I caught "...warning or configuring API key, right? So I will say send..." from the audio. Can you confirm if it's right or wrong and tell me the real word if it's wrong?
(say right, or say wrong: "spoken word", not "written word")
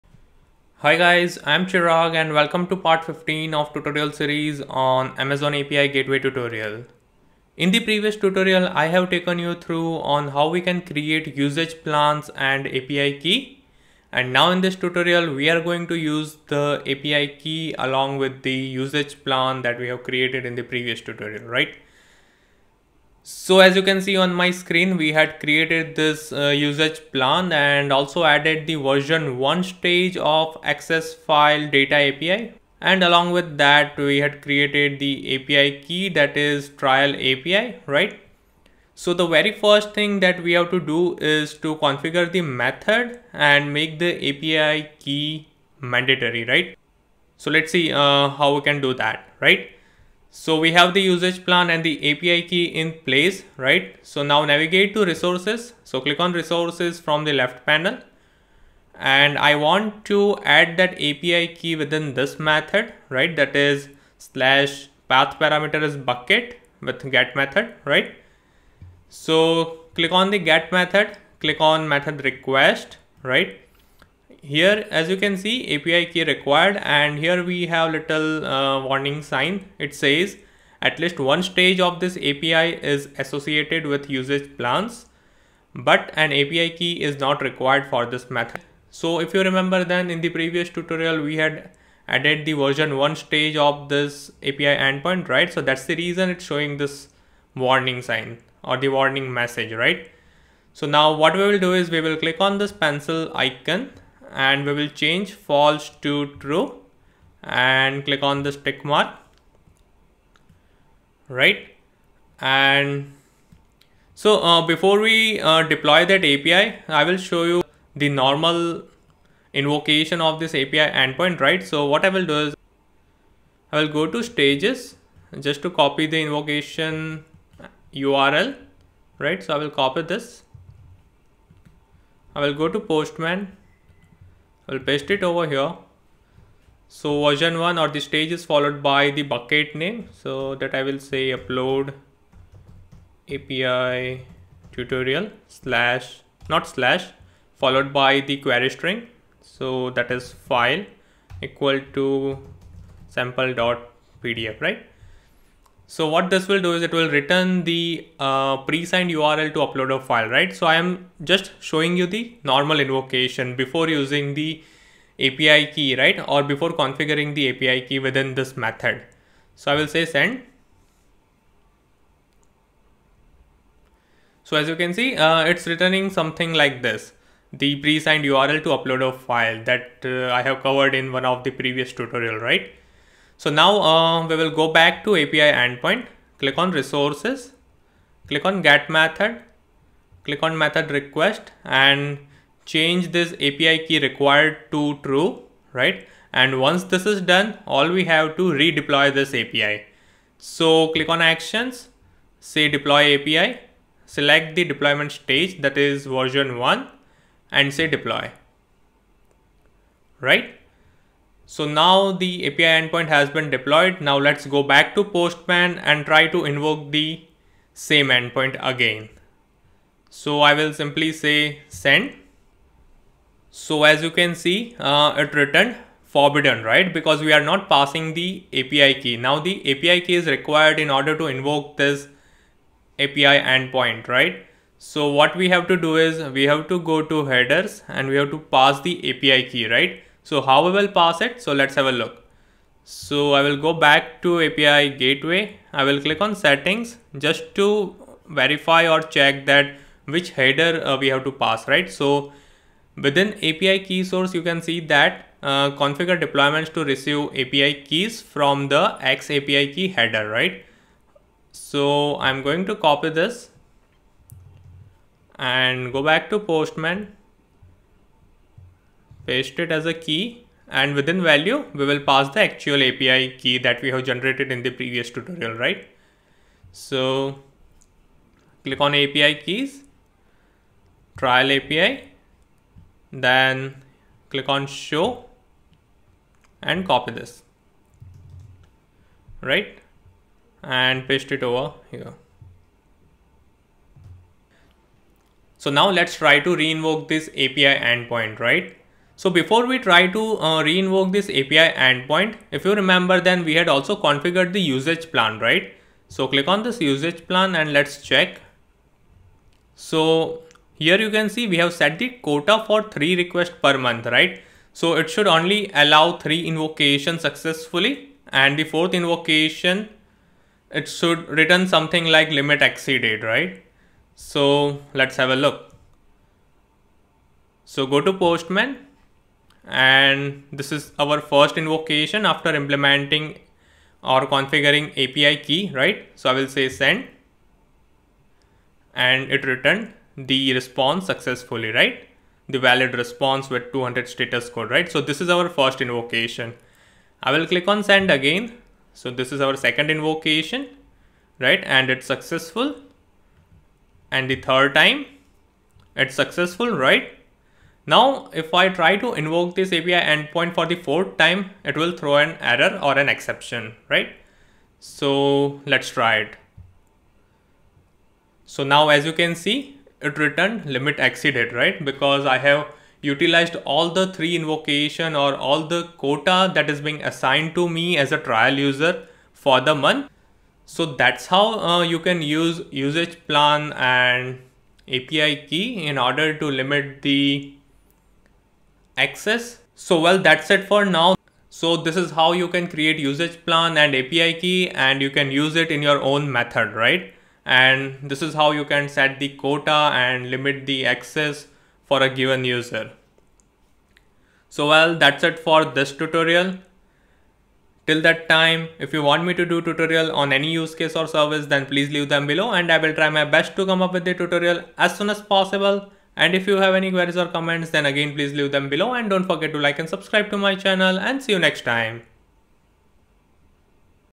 wrong: "implementing", not "warning".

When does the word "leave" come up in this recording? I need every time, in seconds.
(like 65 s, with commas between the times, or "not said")
411 s, 418 s.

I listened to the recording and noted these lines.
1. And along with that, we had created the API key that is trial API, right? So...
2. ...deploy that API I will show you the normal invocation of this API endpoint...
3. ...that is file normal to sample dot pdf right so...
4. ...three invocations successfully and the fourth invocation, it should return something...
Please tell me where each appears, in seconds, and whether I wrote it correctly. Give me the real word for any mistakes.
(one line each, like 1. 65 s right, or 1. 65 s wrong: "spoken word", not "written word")
1. 32 s right
2. 115 s right
3. 149 s wrong: "equal", not "normal"
4. 316 s right.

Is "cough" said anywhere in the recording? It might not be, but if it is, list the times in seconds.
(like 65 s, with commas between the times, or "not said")
not said.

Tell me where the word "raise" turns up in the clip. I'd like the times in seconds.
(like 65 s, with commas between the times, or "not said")
not said.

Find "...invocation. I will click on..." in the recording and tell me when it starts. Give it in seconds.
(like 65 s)
345 s.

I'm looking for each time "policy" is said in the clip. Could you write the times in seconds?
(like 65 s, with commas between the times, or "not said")
not said.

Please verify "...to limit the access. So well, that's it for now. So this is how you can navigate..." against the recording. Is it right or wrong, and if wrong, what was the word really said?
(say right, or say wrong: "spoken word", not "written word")
wrong: "create", not "navigate".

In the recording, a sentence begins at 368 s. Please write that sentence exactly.
So now as you can see, it returned limit exceeded, right?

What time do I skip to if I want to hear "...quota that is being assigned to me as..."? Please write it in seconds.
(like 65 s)
375 s.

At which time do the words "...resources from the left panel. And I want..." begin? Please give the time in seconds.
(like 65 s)
56 s.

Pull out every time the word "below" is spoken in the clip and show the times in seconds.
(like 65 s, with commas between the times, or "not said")
412 s, 418 s.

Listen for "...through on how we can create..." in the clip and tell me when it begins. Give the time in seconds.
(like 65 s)
9 s.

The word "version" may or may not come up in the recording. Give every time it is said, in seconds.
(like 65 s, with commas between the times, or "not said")
28 s, 92 s, 137 s, 206 s.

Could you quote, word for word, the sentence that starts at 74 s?
here as you can see API key required and here we have little uh, warning sign.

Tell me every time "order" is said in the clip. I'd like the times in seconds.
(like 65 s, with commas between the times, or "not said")
230 s, 385 s.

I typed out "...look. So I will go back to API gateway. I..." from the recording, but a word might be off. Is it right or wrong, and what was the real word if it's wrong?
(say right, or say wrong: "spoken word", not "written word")
right.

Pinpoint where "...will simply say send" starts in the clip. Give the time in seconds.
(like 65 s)
220 s.